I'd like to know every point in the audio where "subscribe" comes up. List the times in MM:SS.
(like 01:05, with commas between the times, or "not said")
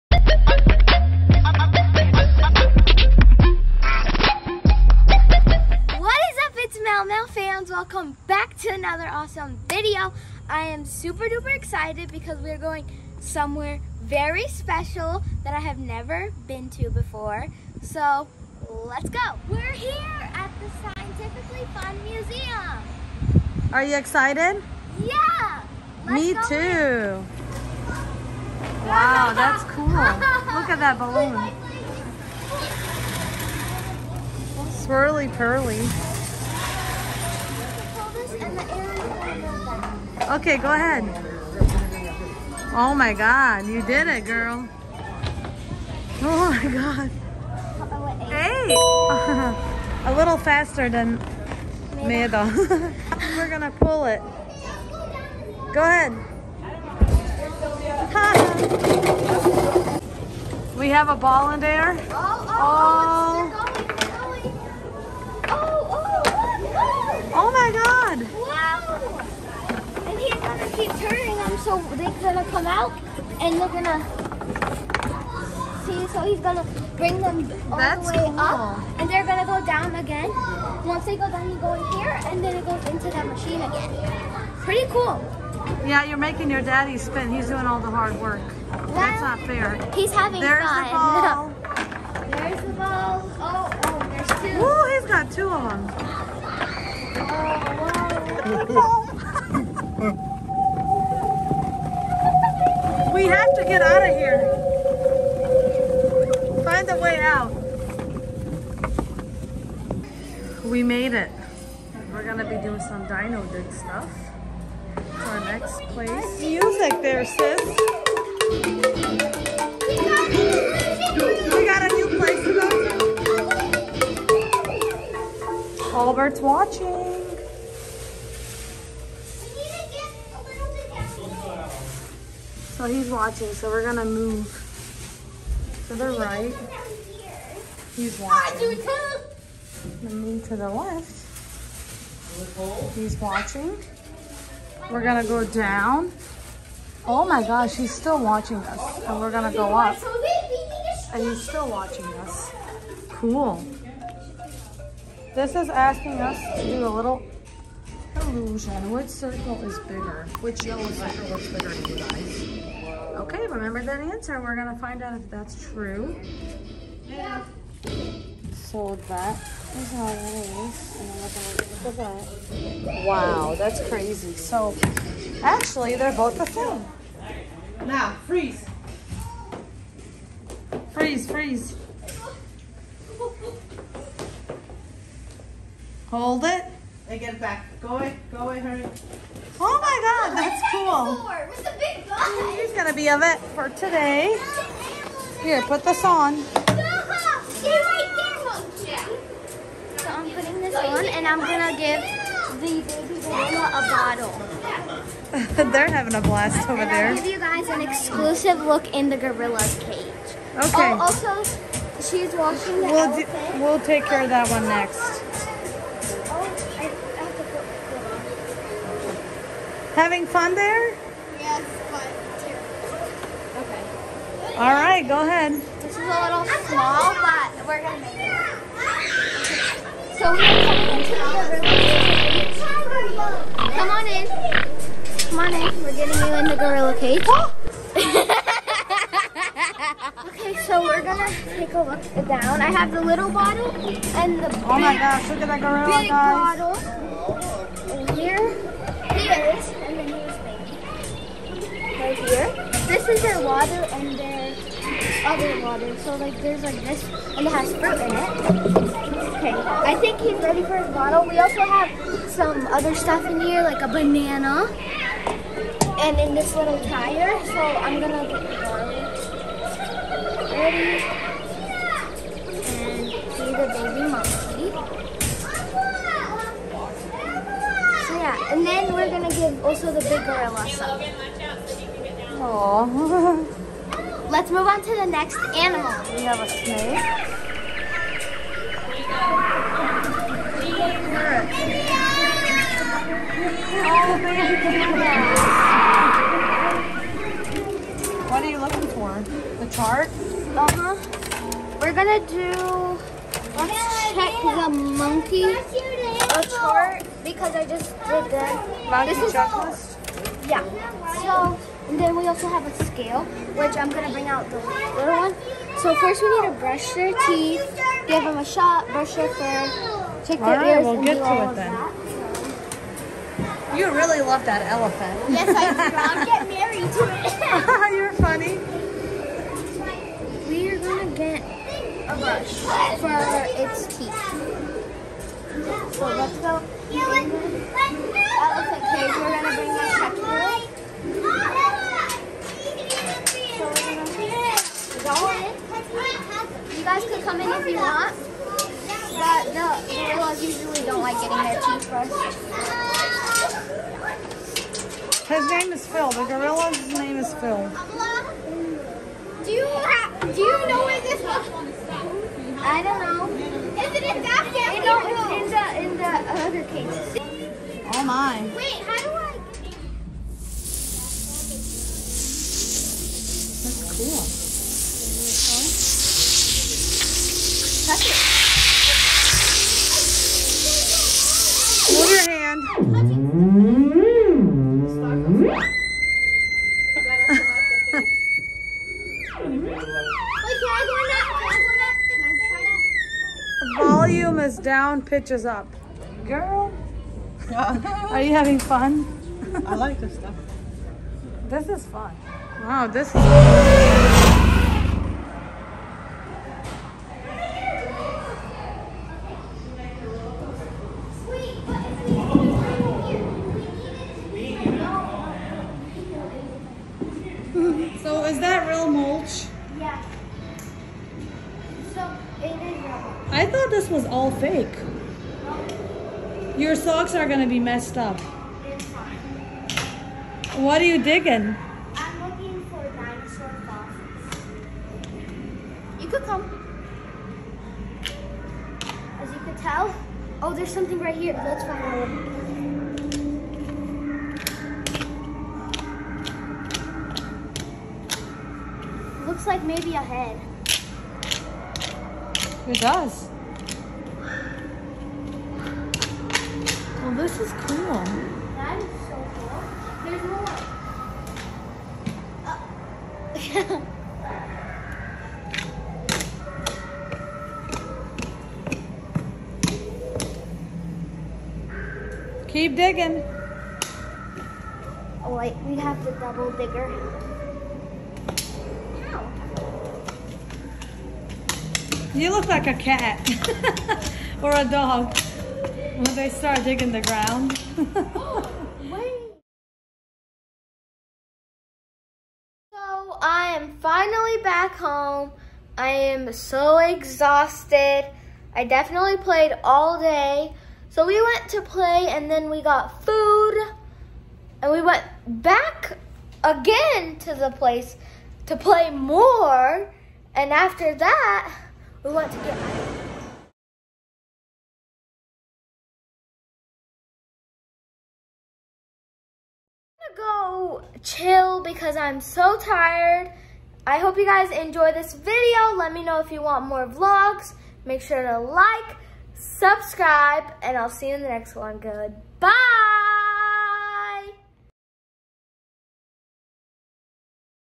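08:49.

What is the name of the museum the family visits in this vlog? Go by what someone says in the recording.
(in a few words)
Scientifically Fun Museum.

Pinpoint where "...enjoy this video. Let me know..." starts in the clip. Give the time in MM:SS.
08:44.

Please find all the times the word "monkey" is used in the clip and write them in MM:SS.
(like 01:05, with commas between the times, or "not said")
04:34, 05:05.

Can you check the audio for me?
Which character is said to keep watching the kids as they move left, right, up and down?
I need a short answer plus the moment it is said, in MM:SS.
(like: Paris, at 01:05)
Albert, at 02:05.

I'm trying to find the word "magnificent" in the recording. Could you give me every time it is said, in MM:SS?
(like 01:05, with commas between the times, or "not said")
not said.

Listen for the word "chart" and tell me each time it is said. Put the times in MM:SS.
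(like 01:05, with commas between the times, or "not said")
04:59, 05:06.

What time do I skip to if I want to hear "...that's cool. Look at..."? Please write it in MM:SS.
00:29.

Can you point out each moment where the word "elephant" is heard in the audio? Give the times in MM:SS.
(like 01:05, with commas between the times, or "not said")
05:24, 05:36.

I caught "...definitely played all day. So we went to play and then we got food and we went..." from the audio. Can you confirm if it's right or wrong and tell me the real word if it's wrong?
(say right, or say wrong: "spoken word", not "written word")
right.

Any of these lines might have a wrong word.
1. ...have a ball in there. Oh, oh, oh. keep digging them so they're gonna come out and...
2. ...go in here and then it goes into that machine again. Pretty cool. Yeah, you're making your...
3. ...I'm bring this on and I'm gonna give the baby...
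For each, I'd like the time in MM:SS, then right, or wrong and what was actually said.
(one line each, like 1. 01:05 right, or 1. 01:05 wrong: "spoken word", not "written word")
1. 01:00 wrong: "turning", not "digging"
2. 01:21 right
3. 03:20 wrong: "putting", not "bring".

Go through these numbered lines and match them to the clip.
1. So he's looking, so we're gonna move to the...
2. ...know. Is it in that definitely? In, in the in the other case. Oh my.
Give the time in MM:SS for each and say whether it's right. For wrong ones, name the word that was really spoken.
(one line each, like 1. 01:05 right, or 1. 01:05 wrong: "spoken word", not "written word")
1. 02:12 wrong: "watching", not "looking"
2. 06:03 wrong: "family", not "definitely".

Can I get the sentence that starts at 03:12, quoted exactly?
gonna be of it for today.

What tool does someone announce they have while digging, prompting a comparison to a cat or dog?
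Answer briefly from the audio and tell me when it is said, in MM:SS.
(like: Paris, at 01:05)
The double digger, at 07:56.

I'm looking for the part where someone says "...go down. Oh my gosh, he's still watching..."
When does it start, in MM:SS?
02:25.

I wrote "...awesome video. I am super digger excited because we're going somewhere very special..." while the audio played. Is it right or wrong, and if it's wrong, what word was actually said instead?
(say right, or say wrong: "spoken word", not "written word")
wrong: "duper", not "digger".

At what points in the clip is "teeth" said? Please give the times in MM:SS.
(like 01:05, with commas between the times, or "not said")
05:17, 05:33, 05:51.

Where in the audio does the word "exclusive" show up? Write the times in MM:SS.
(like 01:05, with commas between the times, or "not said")
03:27.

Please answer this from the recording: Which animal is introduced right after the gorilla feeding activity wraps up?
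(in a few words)
A snake.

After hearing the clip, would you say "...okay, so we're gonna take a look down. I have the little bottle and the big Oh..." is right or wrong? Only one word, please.
right.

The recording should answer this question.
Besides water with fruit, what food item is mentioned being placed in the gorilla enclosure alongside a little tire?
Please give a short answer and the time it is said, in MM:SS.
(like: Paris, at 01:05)
A banana, at 04:23.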